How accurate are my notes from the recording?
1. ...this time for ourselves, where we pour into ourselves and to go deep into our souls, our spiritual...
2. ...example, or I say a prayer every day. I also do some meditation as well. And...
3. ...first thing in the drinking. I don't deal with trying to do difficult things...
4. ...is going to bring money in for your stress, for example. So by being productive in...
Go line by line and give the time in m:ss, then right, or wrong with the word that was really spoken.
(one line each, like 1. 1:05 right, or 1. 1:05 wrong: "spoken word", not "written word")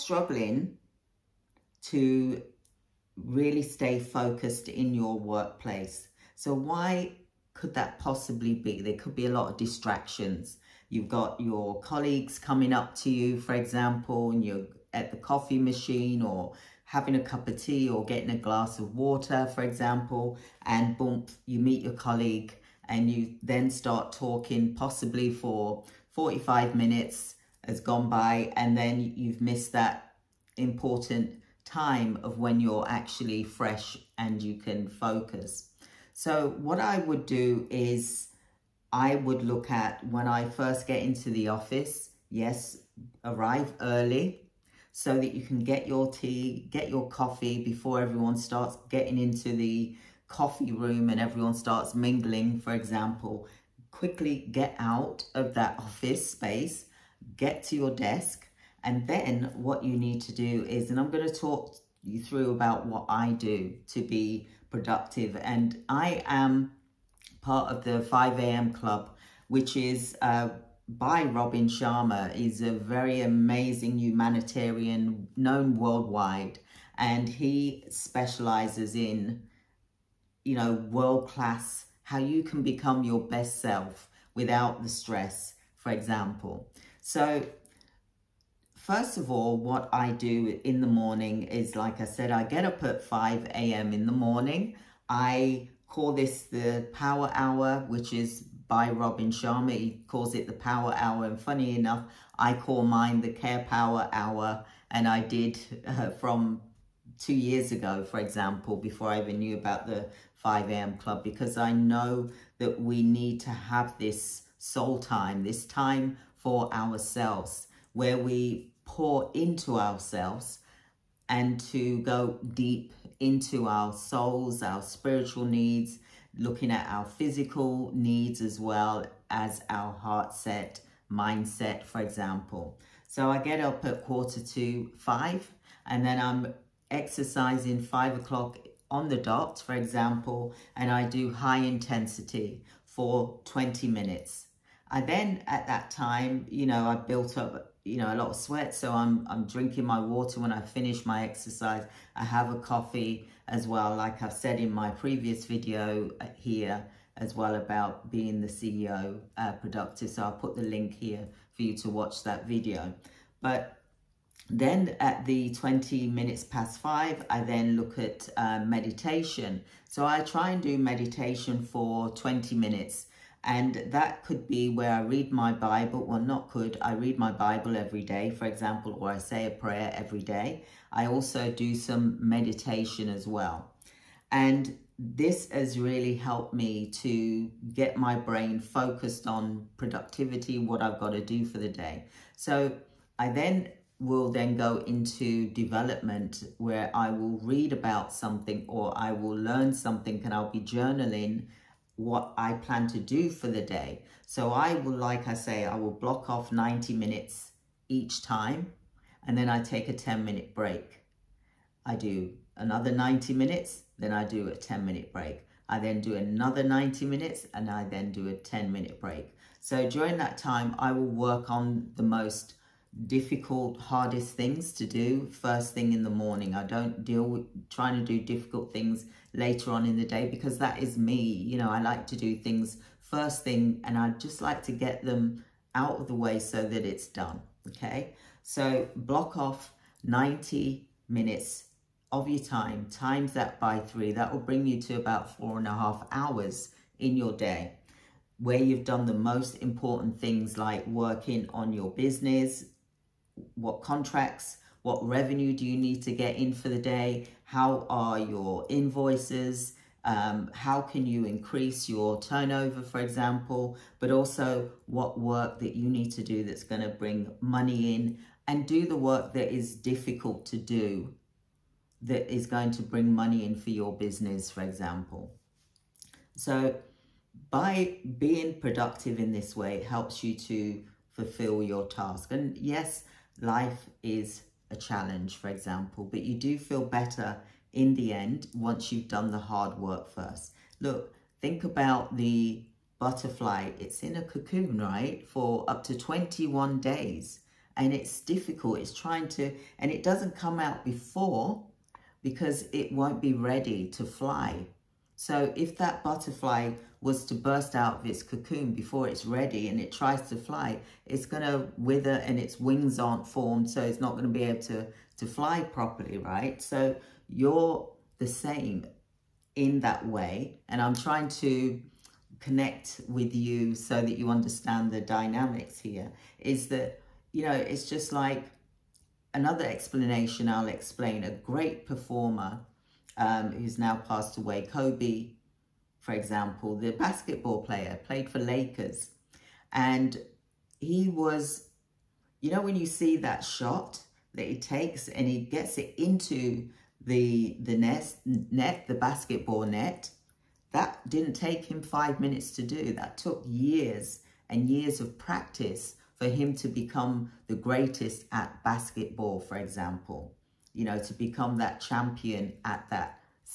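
1. 1:55 right
2. 2:58 right
3. 3:45 wrong: "morning", not "drinking"
4. 4:32 wrong: "business", not "stress".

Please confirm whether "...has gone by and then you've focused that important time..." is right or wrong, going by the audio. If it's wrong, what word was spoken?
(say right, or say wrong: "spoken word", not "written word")
wrong: "missed", not "focused".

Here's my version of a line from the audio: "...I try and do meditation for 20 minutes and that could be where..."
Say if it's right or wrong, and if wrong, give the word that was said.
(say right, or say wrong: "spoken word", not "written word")
right.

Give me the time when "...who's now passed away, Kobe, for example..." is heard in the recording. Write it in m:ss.
5:33.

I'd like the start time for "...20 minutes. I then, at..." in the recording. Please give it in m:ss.
2:23.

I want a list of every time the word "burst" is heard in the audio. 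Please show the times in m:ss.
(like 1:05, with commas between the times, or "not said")
5:07.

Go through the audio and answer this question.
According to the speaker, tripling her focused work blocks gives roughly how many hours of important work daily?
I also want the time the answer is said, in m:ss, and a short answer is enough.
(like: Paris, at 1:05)
4.5 hours, at 4:05.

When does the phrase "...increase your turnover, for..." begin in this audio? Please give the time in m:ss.
4:21.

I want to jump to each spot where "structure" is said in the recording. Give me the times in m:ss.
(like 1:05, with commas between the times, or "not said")
not said.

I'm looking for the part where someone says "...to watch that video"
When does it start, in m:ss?
2:41.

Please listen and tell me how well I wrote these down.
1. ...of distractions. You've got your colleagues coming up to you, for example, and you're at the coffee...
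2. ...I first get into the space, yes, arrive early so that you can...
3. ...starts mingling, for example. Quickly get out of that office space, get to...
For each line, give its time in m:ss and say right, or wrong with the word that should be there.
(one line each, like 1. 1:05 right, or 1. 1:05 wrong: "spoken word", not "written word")
1. 0:09 right
2. 0:40 wrong: "office", not "space"
3. 0:51 right.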